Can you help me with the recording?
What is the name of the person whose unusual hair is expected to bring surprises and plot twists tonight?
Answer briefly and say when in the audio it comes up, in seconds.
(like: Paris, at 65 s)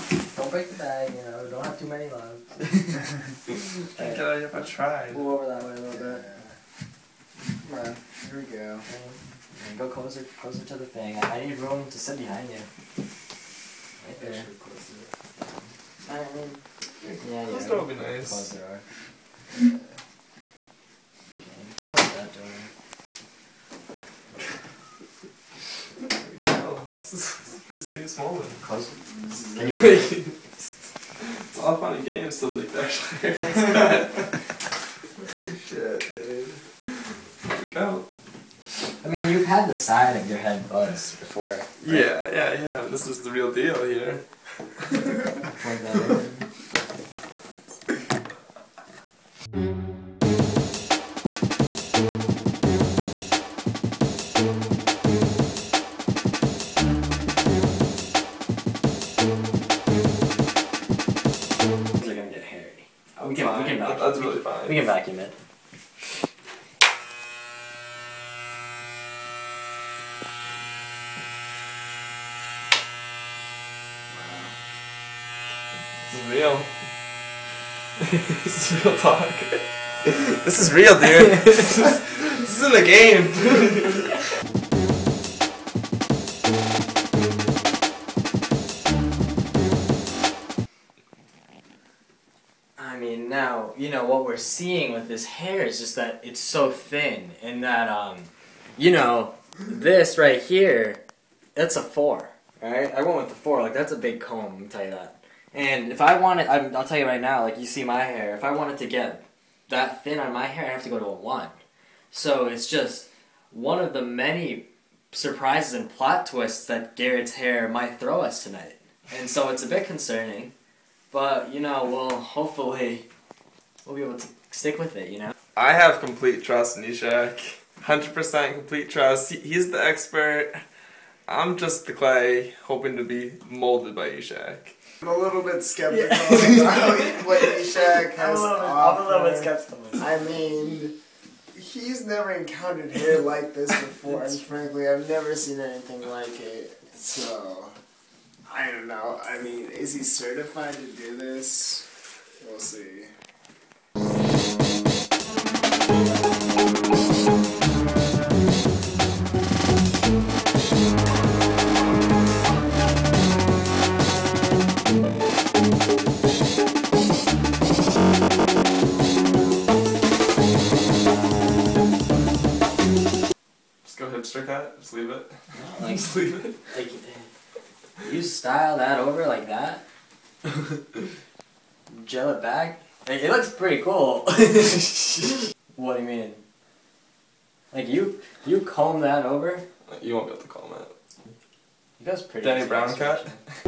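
Garrett, at 116 s.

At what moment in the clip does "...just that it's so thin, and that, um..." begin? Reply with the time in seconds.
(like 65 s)
95 s.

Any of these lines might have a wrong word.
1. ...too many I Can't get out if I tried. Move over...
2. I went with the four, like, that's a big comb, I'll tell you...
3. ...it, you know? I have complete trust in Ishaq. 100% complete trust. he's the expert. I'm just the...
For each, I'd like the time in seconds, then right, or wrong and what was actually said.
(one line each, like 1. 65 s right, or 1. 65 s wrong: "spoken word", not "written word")
1. 1 s right
2. 102 s right
3. 124 s right.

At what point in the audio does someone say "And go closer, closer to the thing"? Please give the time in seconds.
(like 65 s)
9 s.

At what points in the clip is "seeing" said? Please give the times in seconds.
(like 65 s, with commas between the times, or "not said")
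94 s.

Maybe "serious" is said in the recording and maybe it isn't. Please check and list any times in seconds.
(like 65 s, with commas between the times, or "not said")
27 s.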